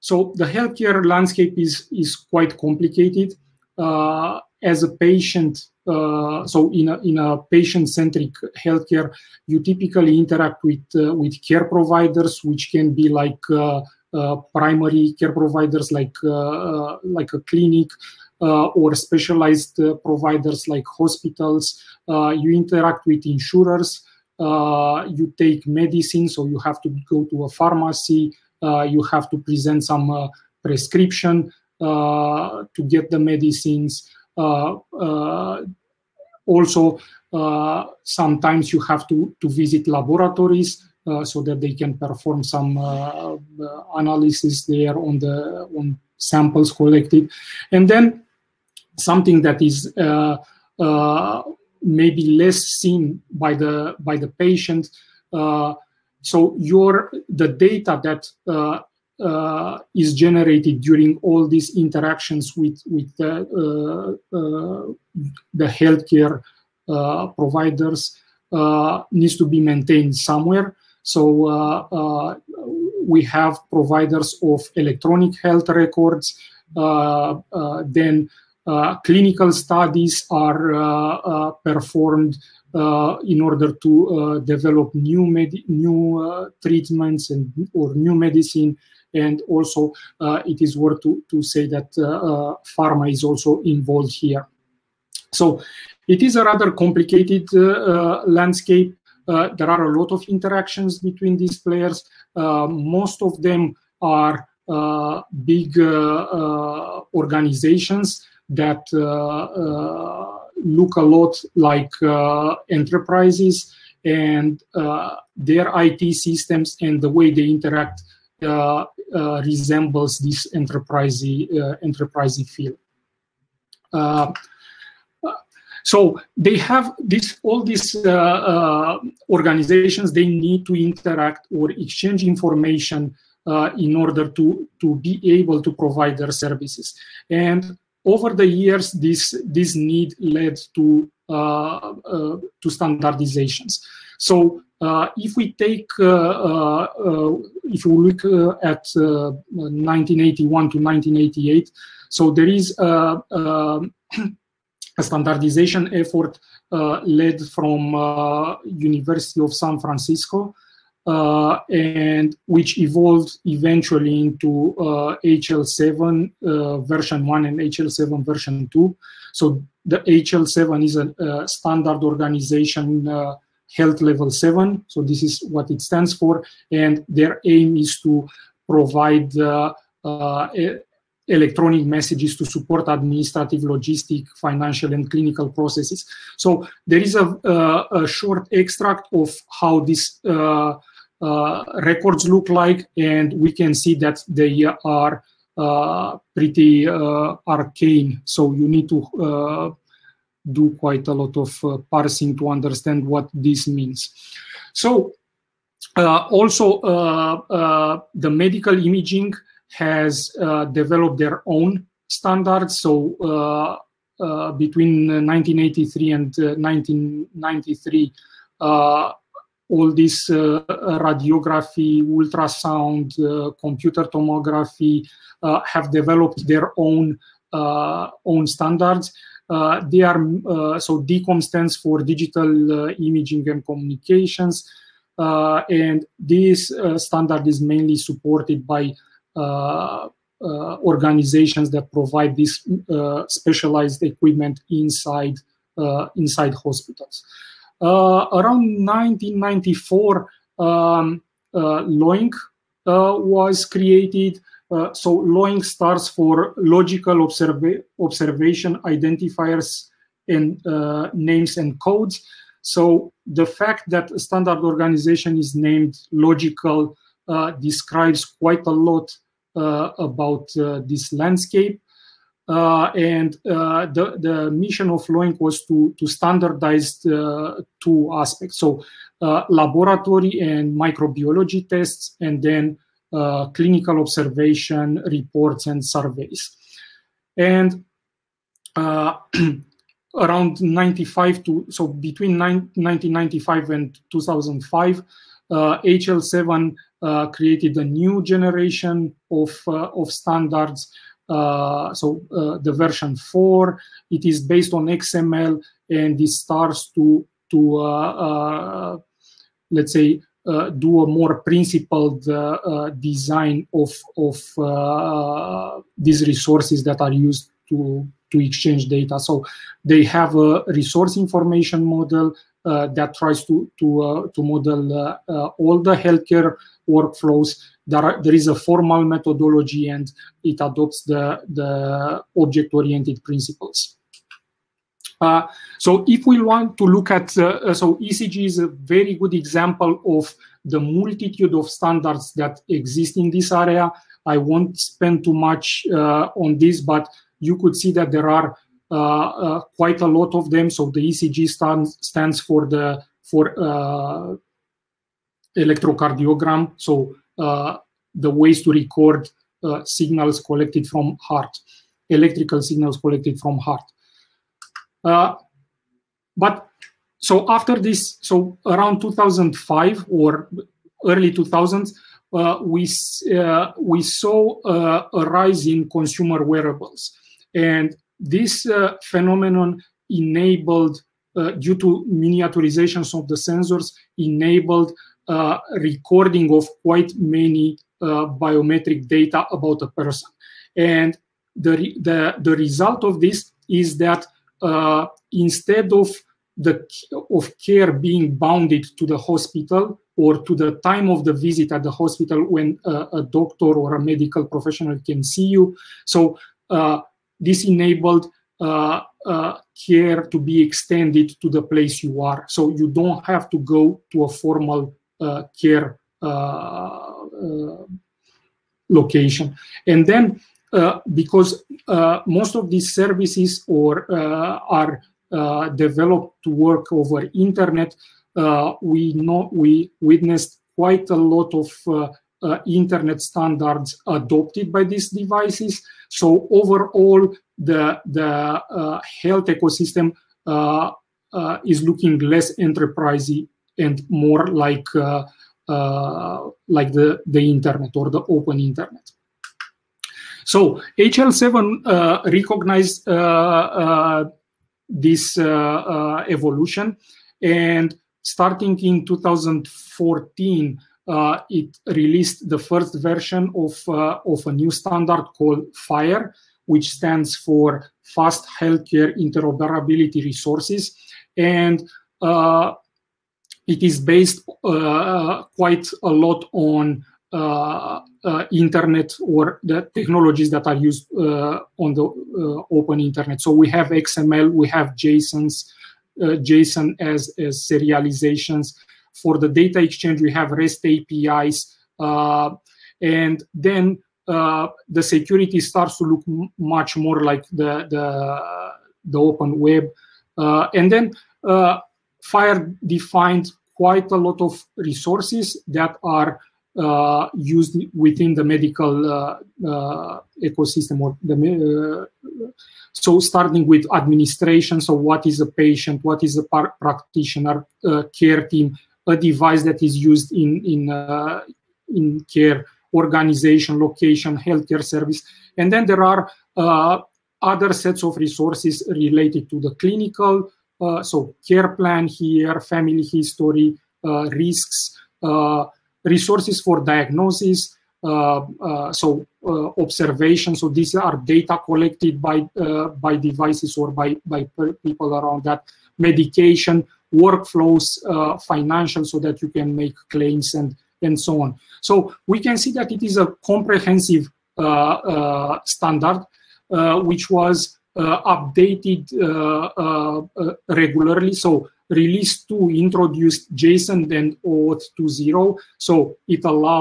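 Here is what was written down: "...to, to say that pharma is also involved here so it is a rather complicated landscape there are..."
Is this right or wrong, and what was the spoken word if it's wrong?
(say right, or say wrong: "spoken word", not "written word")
right.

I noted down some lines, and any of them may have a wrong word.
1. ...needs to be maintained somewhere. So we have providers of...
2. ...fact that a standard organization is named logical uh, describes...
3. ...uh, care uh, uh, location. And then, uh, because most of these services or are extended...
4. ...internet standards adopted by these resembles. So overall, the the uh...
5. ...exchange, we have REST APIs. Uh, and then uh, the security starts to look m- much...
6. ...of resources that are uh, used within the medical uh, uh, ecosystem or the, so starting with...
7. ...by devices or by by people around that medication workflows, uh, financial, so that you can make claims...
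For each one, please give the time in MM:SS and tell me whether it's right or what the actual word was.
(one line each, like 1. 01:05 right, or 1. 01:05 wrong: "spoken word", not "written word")
1. 01:09 right
2. 04:23 right
3. 06:55 wrong: "developed", not "extended"
4. 07:12 wrong: "devices", not "resembles"
5. 08:09 right
6. 08:24 right
7. 09:02 right.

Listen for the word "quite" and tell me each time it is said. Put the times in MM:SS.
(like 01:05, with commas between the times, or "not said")
00:02, 03:20, 04:28, 05:49, 06:26, 07:10, 07:55, 08:23.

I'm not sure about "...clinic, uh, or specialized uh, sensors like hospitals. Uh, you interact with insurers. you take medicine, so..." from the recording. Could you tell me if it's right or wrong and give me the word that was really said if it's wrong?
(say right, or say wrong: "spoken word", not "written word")
wrong: "providers", not "sensors".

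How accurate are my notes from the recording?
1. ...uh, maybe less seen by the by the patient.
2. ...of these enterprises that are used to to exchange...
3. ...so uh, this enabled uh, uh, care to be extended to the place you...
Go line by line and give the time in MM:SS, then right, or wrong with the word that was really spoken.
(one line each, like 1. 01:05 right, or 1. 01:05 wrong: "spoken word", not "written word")
1. 00:50 right
2. 05:14 wrong: "resources", not "enterprises"
3. 06:46 right.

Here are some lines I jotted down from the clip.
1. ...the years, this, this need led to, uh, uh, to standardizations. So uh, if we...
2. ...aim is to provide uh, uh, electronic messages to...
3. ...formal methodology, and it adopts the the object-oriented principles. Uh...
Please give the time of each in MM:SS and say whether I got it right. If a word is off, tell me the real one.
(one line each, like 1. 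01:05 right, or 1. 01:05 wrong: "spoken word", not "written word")
1. 02:18 right
2. 02:57 right
3. 05:28 right.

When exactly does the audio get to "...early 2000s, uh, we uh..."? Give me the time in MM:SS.
06:11.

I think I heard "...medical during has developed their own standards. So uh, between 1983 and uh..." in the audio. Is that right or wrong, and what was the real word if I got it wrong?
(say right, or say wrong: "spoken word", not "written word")
wrong: "imaging", not "during".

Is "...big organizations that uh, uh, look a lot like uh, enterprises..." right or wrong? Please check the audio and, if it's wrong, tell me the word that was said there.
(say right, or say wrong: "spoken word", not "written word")
right.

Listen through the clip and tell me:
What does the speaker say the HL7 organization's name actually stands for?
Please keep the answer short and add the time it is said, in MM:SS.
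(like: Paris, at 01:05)
Health Level 7, at 02:53.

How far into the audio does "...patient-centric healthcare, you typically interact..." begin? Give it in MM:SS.
00:07.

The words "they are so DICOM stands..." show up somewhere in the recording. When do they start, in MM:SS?
03:49.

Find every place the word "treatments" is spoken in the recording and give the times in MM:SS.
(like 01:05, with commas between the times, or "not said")
01:26.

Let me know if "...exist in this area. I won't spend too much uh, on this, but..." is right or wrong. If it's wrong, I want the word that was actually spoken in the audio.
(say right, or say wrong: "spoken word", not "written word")
right.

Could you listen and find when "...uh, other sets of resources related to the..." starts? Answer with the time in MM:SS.
08:46.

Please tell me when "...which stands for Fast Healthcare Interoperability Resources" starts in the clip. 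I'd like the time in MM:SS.
07:46.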